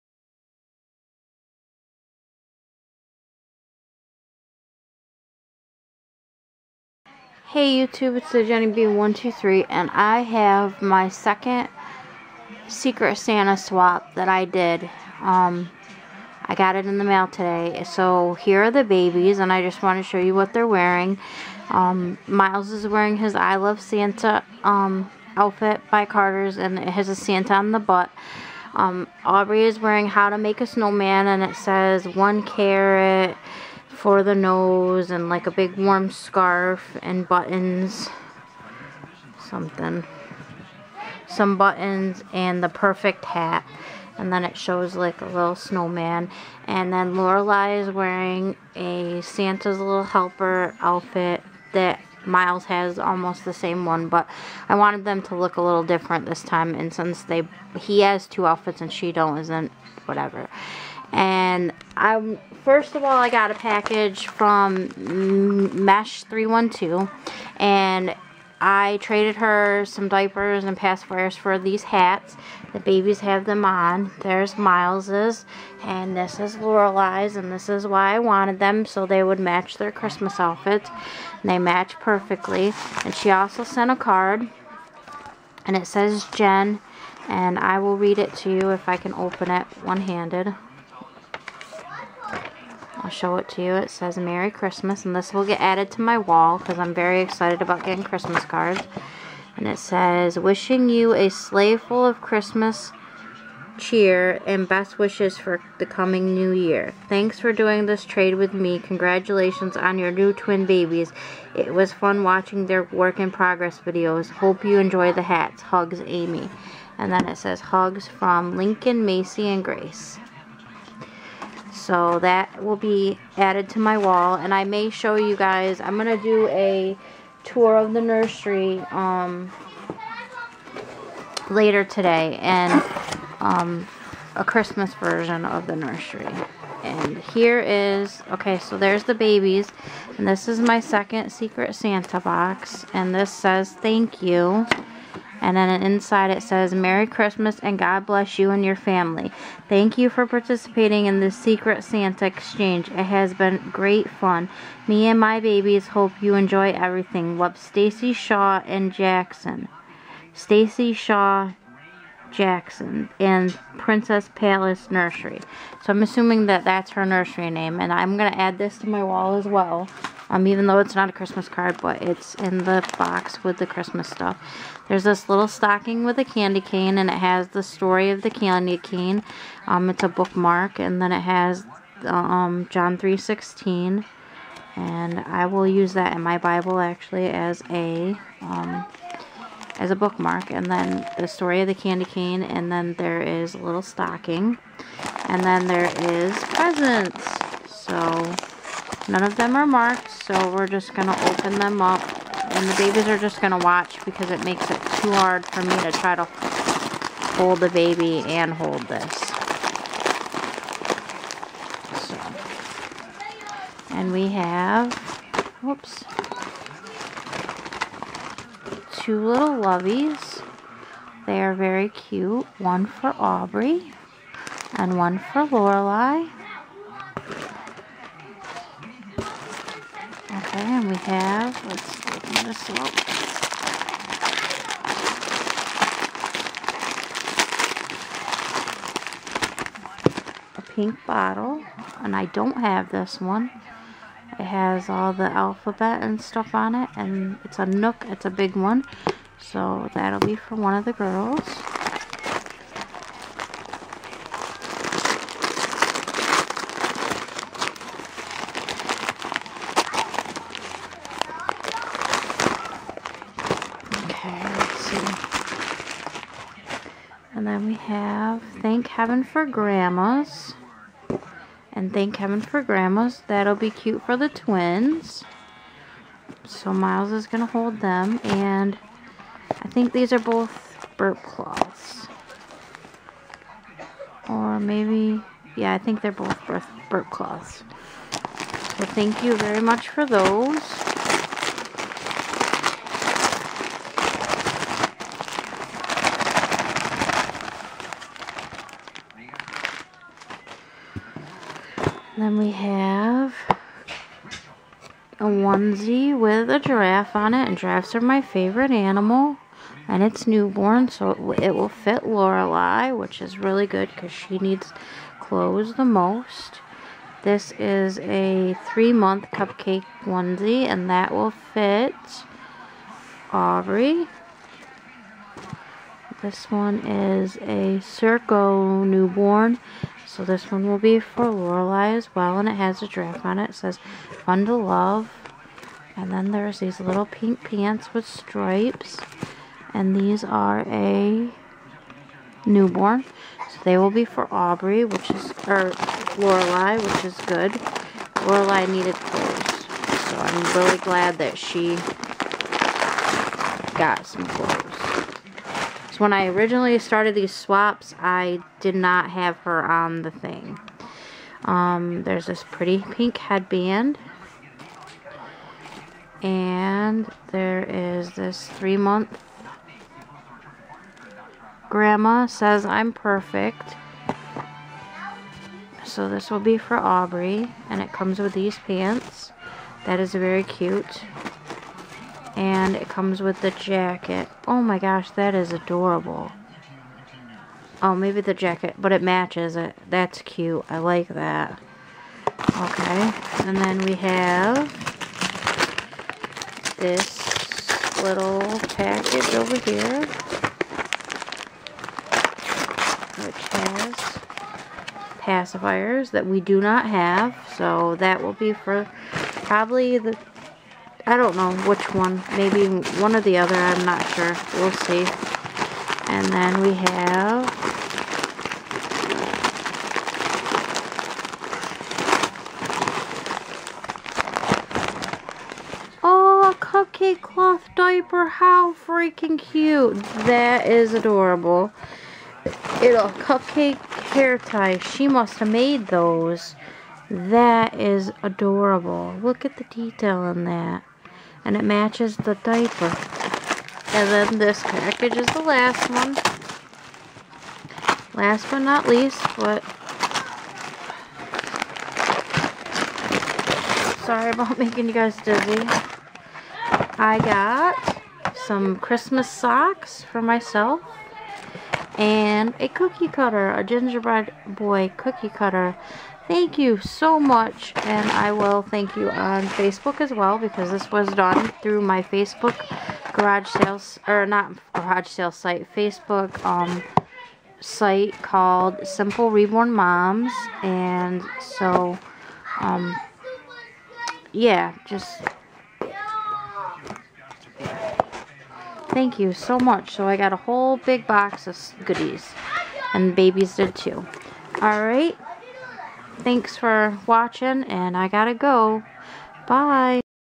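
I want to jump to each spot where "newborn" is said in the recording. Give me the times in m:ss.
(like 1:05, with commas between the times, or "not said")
5:10, 5:28, 5:42.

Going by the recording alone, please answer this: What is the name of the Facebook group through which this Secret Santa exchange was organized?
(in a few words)
Simple Reborn Moms.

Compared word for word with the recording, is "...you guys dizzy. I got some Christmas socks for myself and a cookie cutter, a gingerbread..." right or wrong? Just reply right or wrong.
right.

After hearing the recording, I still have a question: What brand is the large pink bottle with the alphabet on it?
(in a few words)
NUK.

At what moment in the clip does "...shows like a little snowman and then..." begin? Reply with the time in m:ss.
0:44.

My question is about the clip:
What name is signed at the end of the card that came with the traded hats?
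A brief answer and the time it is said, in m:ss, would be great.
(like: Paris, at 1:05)
Amy, at 1:56.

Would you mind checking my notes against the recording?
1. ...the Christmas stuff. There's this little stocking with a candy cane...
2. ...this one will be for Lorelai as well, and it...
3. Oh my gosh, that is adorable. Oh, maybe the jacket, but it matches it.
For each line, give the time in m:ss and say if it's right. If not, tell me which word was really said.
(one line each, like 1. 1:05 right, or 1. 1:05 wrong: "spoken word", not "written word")
1. 2:53 right
2. 5:30 right
3. 6:24 right.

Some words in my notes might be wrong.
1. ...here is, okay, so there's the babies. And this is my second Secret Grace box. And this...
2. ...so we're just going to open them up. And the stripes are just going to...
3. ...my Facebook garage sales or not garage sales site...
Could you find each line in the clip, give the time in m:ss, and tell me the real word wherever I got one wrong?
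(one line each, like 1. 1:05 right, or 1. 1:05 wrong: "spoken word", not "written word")
1. 2:17 wrong: "Santa", not "Grace"
2. 3:20 wrong: "babies", not "stripes"
3. 7:51 right.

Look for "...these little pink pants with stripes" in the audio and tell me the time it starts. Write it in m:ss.
5:36.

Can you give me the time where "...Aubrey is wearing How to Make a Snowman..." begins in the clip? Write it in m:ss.
0:29.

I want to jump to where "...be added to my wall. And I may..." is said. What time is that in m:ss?
2:02.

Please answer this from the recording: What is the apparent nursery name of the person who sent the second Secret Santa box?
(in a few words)
Princess Palace Nursery.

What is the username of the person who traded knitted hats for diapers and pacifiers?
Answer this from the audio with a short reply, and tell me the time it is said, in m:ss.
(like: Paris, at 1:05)
Mesh 312, at 1:05.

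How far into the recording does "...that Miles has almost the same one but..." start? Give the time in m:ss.
0:51.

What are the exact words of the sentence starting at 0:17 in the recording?
So here are the babies and I just want to show you what they're wearing.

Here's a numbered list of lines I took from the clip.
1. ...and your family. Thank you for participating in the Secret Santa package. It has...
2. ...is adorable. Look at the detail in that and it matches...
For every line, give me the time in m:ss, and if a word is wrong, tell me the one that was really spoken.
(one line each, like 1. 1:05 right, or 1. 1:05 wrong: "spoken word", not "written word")
1. 2:28 wrong: "exchange", not "package"
2. 7:17 right.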